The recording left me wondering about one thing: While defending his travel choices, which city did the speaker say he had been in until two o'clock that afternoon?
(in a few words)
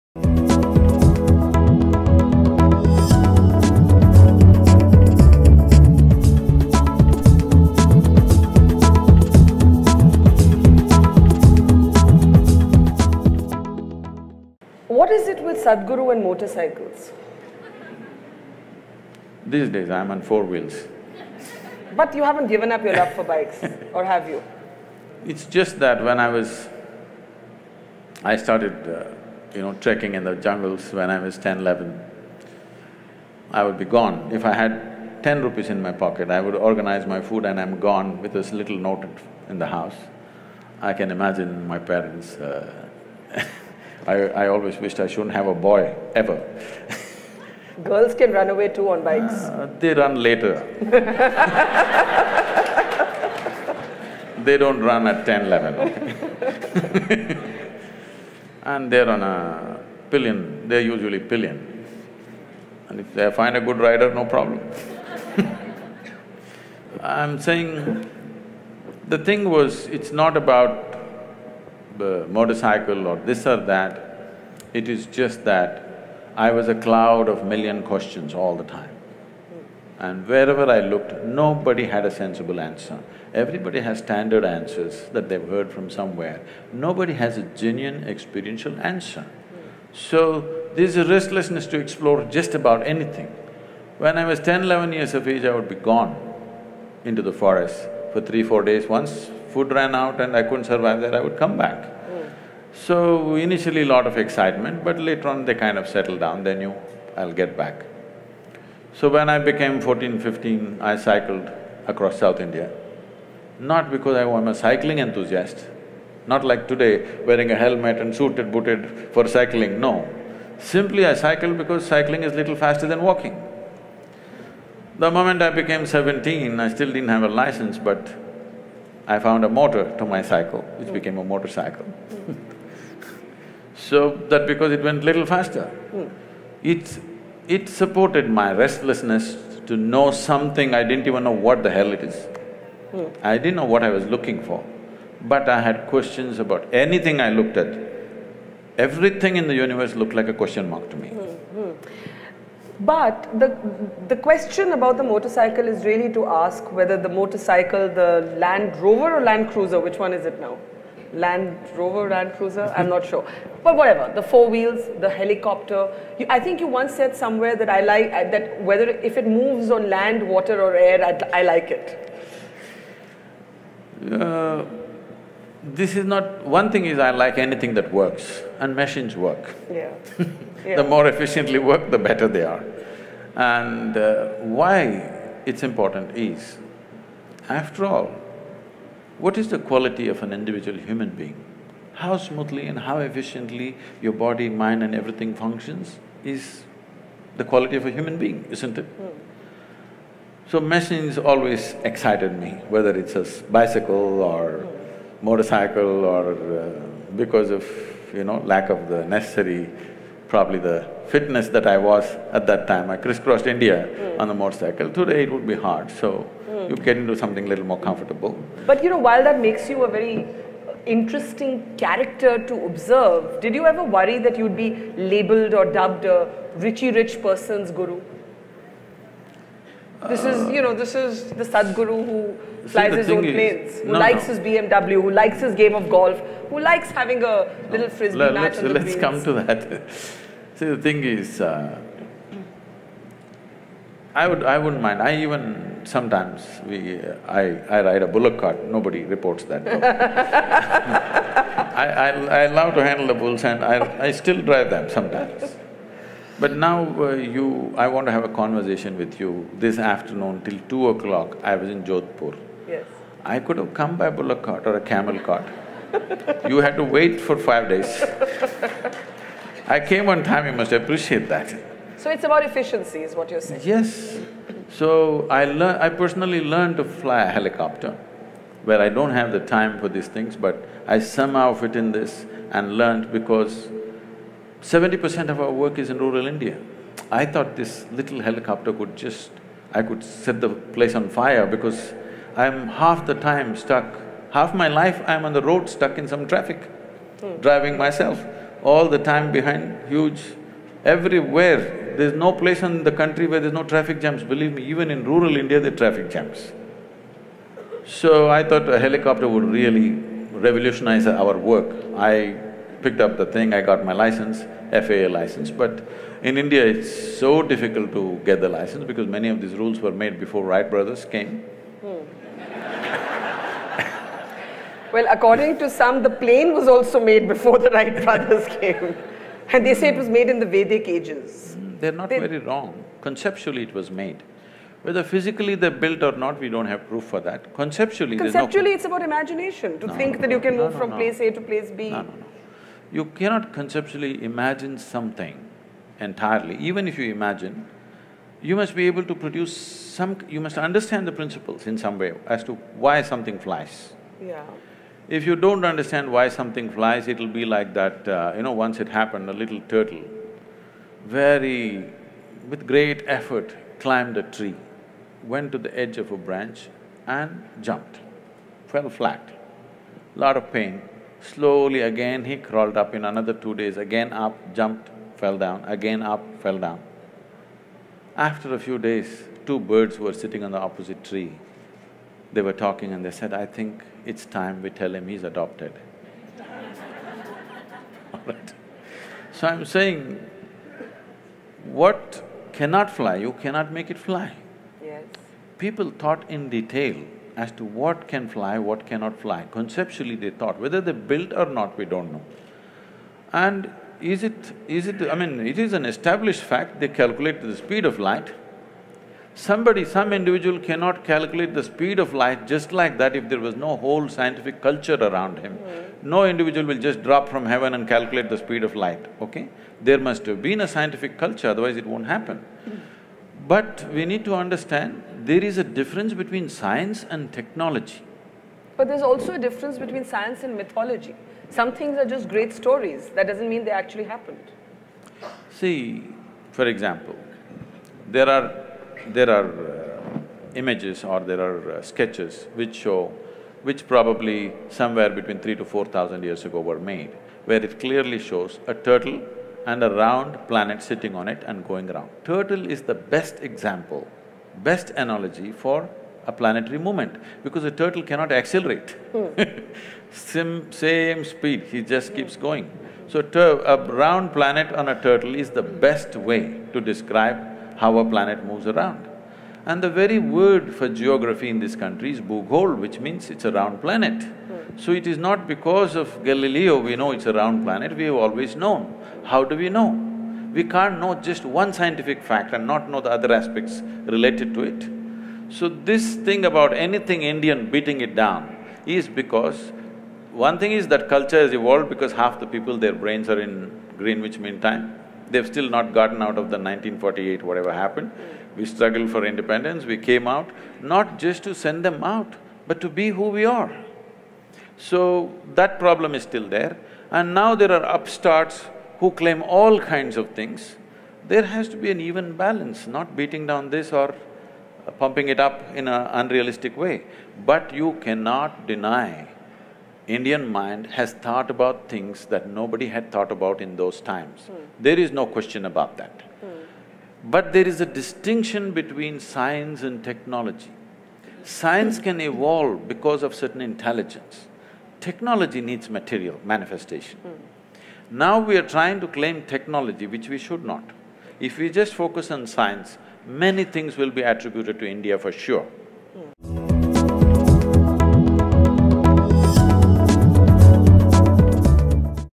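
Jodhpur.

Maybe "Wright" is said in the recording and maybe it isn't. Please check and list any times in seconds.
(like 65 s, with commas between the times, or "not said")
320 s, 327 s.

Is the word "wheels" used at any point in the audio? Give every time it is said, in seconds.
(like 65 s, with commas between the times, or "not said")
20 s, 164 s.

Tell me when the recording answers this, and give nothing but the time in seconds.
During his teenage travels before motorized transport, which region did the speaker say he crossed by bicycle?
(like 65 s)
112 s.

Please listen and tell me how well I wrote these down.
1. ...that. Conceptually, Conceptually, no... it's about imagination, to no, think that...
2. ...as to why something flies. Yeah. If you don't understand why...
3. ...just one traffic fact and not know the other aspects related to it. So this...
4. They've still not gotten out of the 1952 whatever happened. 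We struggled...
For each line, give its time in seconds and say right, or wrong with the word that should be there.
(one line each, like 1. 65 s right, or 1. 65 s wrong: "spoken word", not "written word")
1. 337 s right
2. 352 s right
3. 481 s wrong: "scientific", not "traffic"
4. 495 s wrong: "1948", not "1952".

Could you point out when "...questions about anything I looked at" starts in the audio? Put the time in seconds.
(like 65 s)
145 s.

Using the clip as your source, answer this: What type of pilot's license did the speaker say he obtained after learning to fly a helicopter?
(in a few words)
FAA license.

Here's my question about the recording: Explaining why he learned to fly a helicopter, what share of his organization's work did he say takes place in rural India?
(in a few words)
70 percent.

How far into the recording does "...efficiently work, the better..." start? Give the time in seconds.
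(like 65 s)
181 s.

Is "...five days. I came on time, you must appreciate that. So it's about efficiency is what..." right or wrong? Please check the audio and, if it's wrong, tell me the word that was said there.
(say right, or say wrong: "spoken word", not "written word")
right.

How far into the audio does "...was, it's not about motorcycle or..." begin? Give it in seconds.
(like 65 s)
69 s.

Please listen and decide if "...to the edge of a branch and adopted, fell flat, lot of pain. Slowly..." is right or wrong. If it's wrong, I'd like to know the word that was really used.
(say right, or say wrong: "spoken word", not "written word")
wrong: "jumped", not "adopted".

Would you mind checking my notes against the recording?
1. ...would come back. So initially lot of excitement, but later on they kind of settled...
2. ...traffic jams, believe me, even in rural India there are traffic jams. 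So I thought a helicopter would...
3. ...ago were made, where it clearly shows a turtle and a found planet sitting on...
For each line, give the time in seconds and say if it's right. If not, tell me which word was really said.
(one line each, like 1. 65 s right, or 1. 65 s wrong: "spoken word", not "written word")
1. 101 s right
2. 303 s right
3. 446 s wrong: "round", not "found".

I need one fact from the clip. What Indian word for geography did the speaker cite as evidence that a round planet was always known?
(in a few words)
bhughol.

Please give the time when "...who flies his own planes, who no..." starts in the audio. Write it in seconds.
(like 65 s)
232 s.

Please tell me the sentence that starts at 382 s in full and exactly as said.
They were talking and they said, I think it's time we tell him he's adopted.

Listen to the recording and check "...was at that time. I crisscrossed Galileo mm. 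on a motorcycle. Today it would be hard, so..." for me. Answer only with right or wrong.
wrong.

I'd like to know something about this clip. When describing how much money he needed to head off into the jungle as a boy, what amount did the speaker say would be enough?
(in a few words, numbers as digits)
10 rupees.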